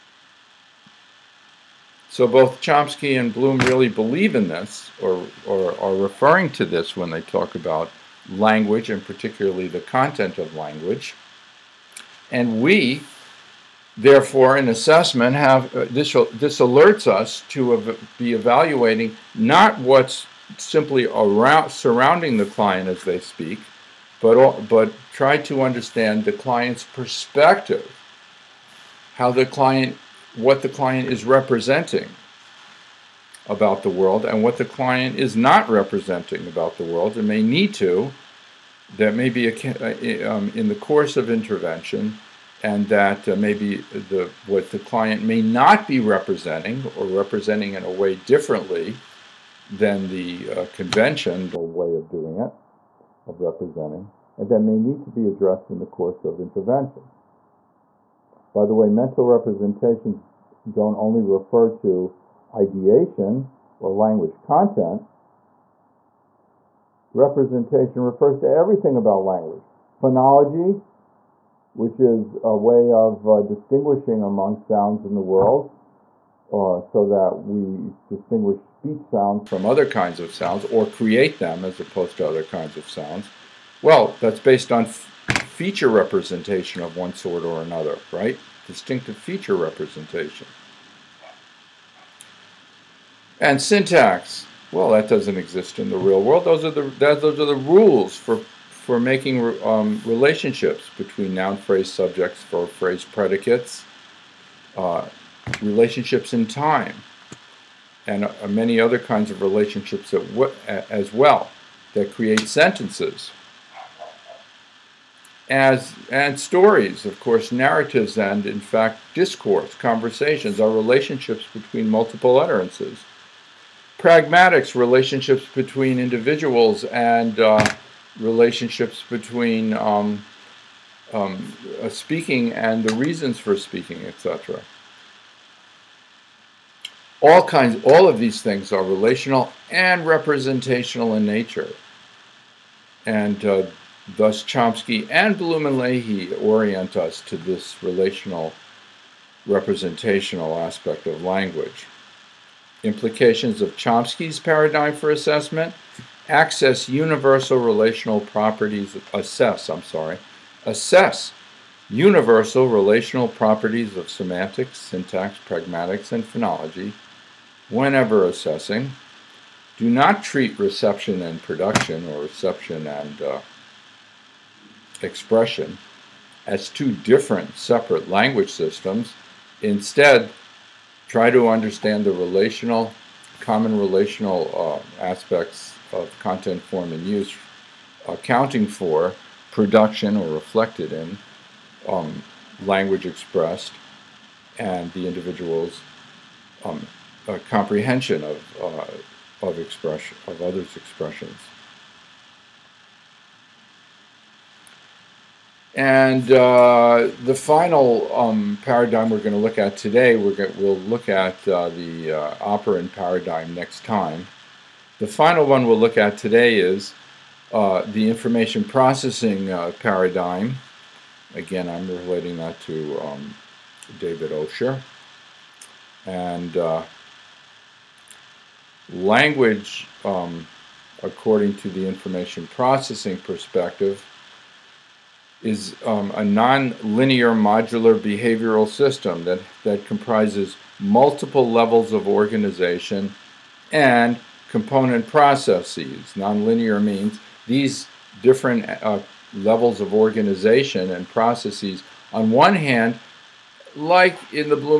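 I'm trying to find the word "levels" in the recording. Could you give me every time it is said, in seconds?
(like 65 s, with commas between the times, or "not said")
241 s, 249 s.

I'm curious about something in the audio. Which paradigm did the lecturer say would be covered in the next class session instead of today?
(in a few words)
Operant paradigm.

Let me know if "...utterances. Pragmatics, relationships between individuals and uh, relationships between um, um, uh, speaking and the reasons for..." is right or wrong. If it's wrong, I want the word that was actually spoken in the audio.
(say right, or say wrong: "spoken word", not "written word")
right.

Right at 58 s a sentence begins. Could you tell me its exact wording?
By the way, mental representations don't only refer to ideation or language content.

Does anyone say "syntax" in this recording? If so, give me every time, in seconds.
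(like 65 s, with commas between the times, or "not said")
93 s, 164 s.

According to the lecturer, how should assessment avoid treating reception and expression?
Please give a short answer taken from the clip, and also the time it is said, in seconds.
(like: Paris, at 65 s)
Two different separate language systems, at 176 s.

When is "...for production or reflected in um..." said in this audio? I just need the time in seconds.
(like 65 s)
188 s.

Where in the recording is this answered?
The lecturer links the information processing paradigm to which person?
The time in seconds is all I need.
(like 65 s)
223 s.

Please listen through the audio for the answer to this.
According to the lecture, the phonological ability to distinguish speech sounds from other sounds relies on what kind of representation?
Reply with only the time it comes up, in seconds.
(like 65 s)
88 s.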